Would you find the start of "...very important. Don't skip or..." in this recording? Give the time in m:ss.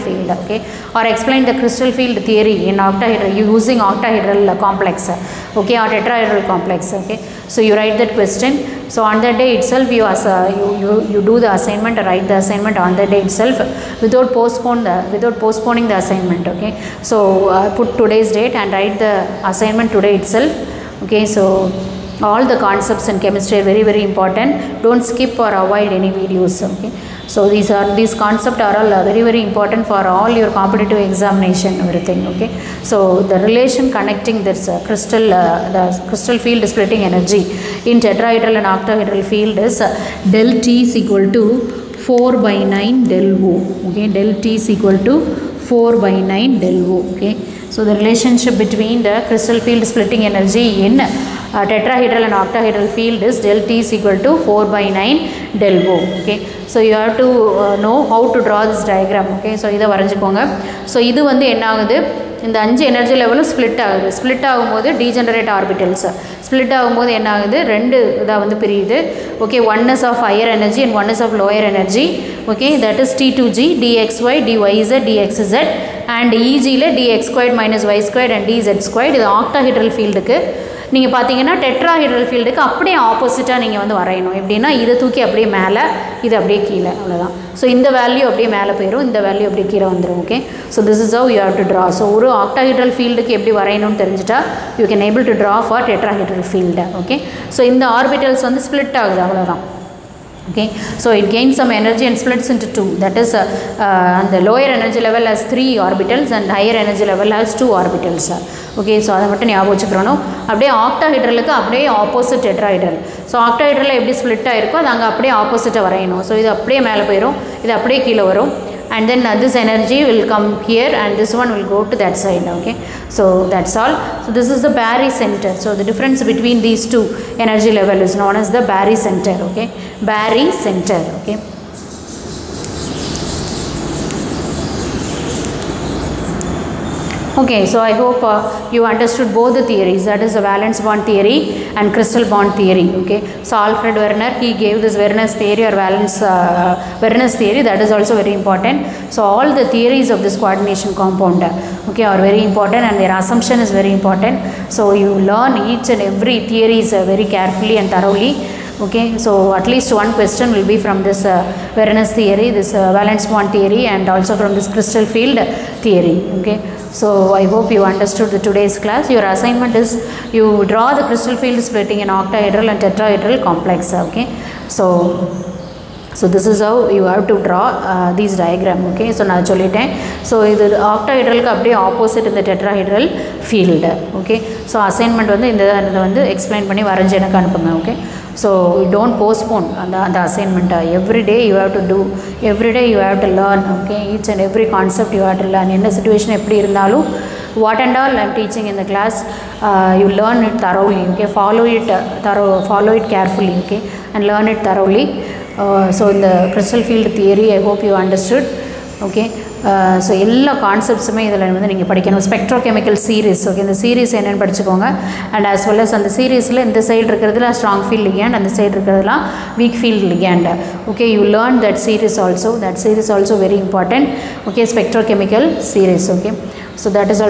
0:23.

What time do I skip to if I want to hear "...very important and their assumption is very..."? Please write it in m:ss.
2:32.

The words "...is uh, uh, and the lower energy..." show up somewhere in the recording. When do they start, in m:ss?
1:43.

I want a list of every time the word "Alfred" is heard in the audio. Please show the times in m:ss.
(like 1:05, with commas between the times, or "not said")
2:23.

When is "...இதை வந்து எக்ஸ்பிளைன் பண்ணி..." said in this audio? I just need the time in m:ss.
3:05.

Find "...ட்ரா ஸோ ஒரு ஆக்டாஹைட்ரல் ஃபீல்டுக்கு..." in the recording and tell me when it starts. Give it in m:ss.
1:31.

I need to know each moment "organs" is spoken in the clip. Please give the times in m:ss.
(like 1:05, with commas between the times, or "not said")
not said.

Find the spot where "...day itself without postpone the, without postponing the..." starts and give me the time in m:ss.
0:13.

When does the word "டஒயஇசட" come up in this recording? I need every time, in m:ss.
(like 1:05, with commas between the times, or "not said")
1:14.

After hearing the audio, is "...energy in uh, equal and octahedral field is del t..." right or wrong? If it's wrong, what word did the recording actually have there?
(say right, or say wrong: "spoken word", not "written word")
wrong: "tetrahedral", not "equal".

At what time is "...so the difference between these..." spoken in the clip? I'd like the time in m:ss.
2:05.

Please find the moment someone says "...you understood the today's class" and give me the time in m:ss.
2:47.